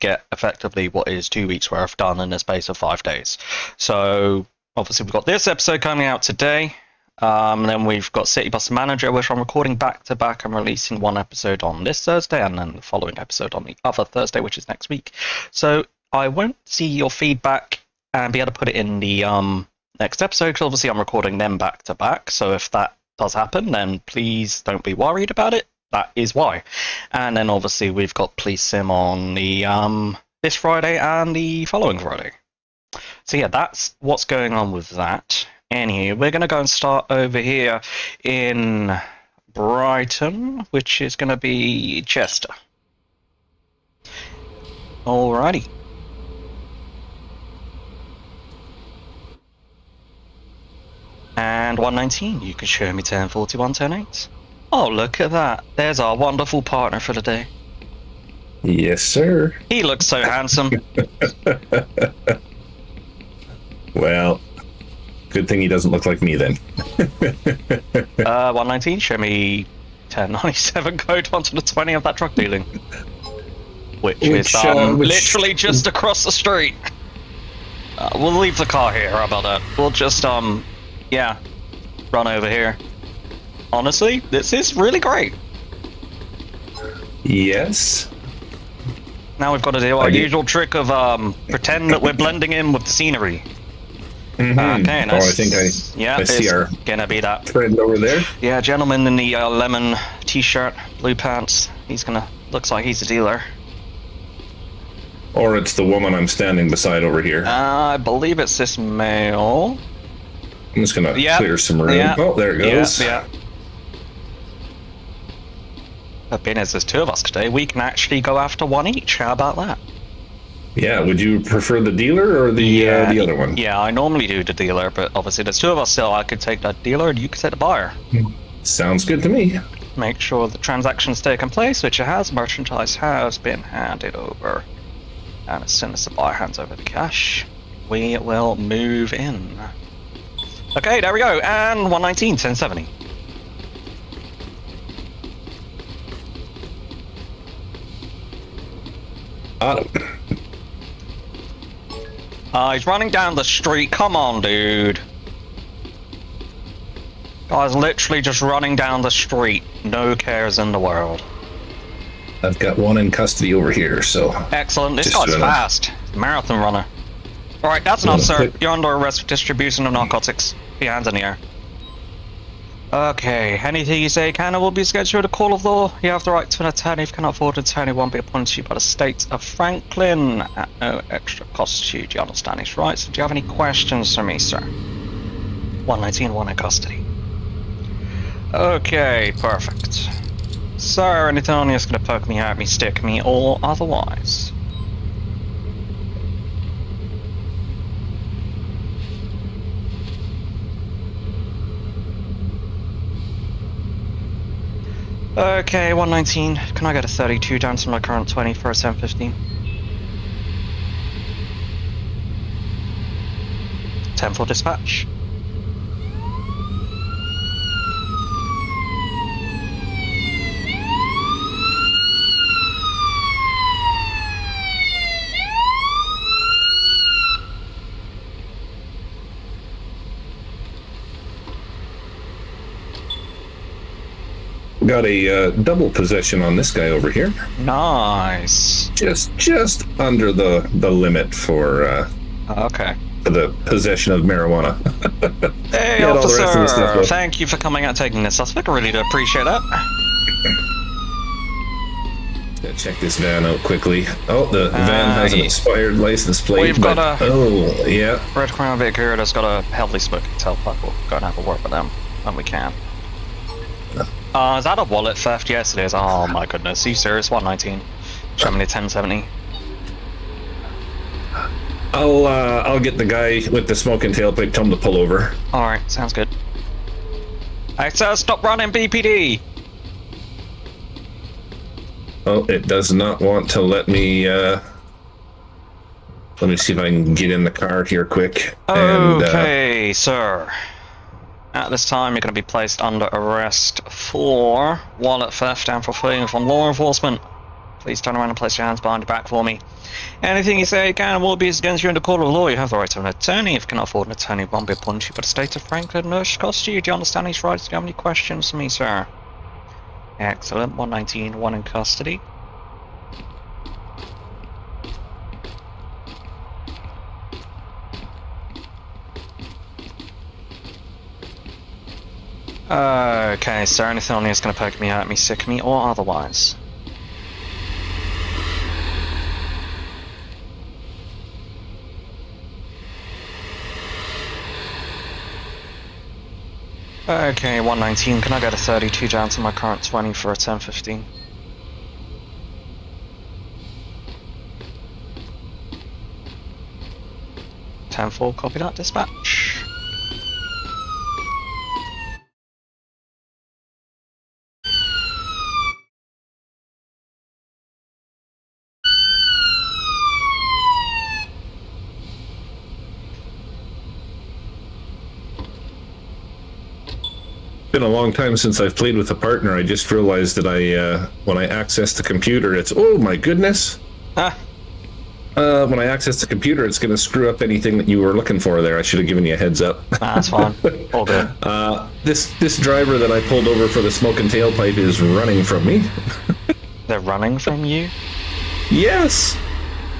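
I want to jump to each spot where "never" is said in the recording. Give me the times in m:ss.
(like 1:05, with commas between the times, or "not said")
not said.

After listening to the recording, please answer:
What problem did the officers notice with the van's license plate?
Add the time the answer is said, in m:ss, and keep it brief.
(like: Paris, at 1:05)
Expired, at 4:15.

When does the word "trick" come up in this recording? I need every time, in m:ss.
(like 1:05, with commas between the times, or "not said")
1:30.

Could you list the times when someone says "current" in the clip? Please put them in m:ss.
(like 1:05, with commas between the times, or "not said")
3:27, 5:39.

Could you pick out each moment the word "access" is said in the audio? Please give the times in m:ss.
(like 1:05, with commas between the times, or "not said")
6:11, 6:15.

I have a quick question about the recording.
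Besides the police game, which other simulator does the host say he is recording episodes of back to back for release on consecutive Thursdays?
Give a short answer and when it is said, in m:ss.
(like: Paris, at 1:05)
City Bus Manager, at 0:08.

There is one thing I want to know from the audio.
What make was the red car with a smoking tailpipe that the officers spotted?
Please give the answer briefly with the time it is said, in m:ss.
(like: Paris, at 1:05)
Crown Vic, at 4:18.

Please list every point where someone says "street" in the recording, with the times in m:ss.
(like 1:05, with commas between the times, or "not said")
1:16, 2:33, 2:39.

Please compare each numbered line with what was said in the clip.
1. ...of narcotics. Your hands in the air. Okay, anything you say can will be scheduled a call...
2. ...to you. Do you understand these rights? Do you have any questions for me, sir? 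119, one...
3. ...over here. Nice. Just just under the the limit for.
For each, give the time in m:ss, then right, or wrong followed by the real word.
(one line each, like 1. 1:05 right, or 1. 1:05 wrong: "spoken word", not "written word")
1. 2:49 right
2. 3:01 right
3. 3:56 right.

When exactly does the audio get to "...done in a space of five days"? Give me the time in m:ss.
0:01.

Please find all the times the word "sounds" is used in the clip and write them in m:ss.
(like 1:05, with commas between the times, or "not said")
2:08, 4:35.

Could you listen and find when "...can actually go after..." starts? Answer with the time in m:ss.
1:57.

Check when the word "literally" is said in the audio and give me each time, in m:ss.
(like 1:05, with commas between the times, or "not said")
1:15, 2:37.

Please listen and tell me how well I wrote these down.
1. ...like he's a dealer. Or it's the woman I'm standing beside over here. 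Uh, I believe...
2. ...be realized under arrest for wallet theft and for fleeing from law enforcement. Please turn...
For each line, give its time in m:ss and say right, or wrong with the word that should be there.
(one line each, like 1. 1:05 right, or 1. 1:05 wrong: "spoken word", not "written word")
1. 1:42 right
2. 4:52 wrong: "placed", not "realized".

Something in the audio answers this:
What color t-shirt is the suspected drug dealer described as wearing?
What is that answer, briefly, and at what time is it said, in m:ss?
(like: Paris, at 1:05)
Lemon, at 1:39.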